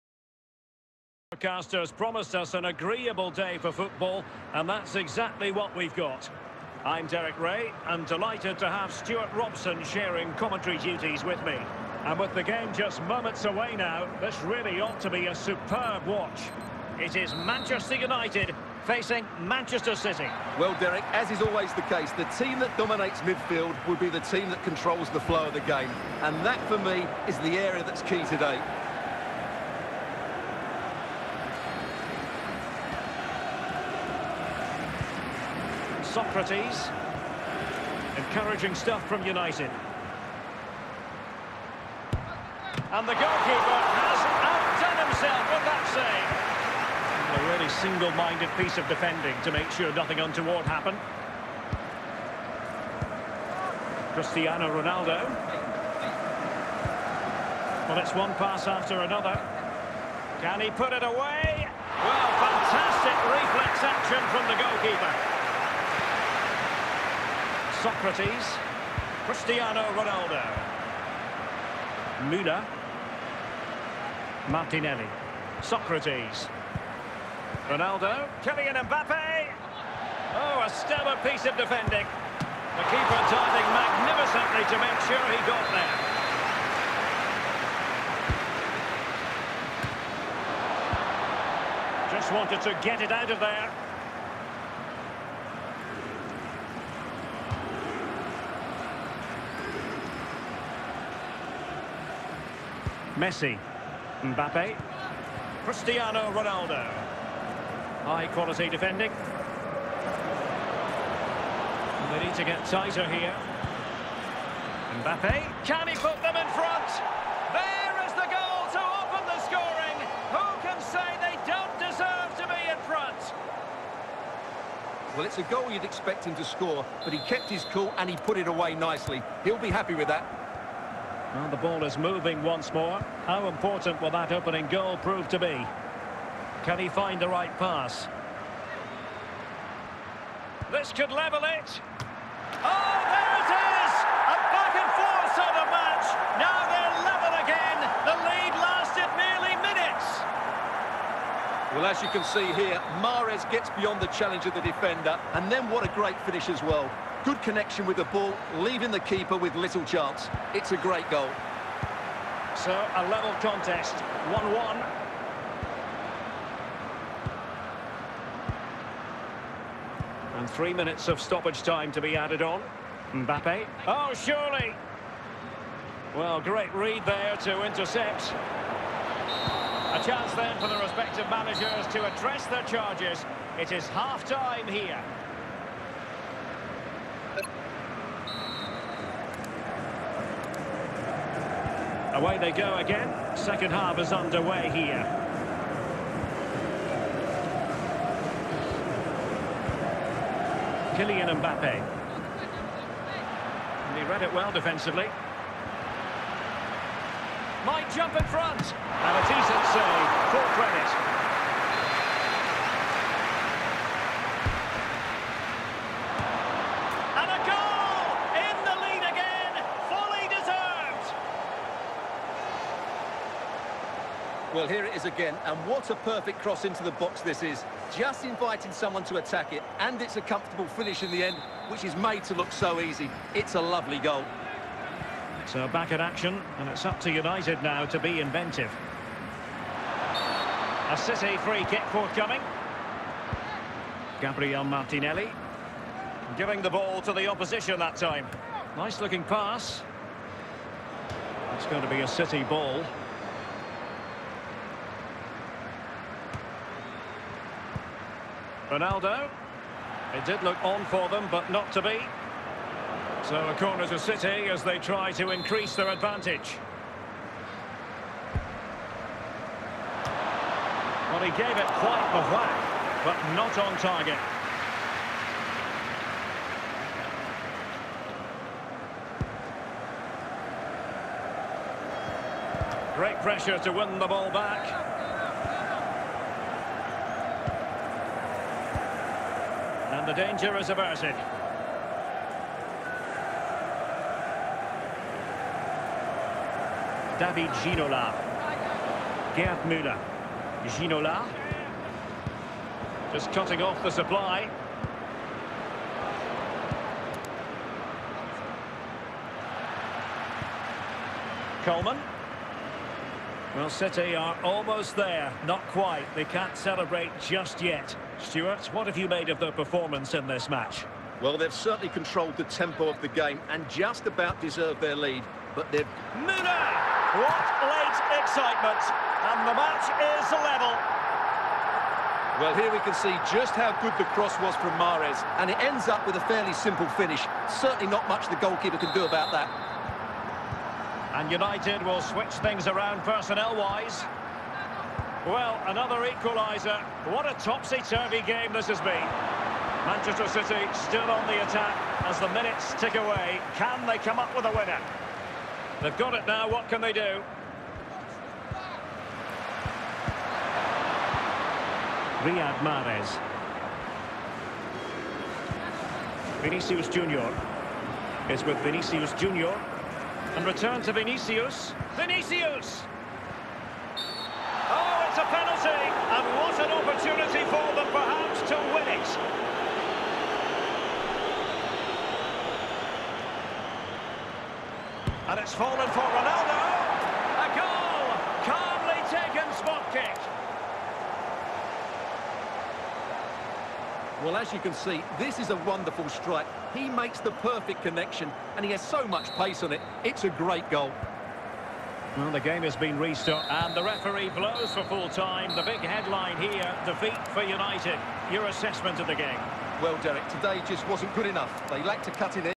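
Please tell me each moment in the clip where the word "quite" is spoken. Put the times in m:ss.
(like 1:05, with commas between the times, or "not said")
4:31, 5:15.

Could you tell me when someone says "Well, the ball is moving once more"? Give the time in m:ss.
2:11.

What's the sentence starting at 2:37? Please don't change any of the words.
Good connection with the ball, leaving the keeper with little chance.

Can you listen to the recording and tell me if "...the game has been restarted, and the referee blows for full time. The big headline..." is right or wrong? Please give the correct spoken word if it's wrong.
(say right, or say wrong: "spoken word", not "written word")
right.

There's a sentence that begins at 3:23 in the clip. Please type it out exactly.
And he read it well defensively might jump in front.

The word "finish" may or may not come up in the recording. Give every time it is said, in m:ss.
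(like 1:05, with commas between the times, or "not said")
2:36, 3:50, 5:36.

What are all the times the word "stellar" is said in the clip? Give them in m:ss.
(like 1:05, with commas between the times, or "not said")
1:20.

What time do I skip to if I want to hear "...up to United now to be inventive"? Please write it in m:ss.
3:56.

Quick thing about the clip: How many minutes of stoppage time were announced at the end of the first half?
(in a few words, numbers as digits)
3.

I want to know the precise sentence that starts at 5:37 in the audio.
Certainly not much the goalkeeper can do about that.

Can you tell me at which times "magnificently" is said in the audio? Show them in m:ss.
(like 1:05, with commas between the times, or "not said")
1:23.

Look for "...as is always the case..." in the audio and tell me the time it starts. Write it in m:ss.
0:21.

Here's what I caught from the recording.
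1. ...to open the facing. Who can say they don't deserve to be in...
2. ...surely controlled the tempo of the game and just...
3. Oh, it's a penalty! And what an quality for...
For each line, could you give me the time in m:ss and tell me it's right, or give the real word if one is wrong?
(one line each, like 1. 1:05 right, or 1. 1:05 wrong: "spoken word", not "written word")
1. 1:58 wrong: "scoring", not "facing"
2. 5:21 wrong: "certainly", not "surely"
3. 6:14 wrong: "opportunity", not "quality".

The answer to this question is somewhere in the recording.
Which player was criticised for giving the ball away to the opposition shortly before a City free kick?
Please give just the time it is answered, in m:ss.
4:04.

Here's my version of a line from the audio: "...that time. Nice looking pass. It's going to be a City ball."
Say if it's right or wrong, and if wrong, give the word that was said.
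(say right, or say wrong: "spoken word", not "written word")
right.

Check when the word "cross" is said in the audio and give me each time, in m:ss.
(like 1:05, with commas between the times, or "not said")
3:46, 5:34.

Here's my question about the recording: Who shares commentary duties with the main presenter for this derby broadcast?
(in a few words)
Stuart Robson.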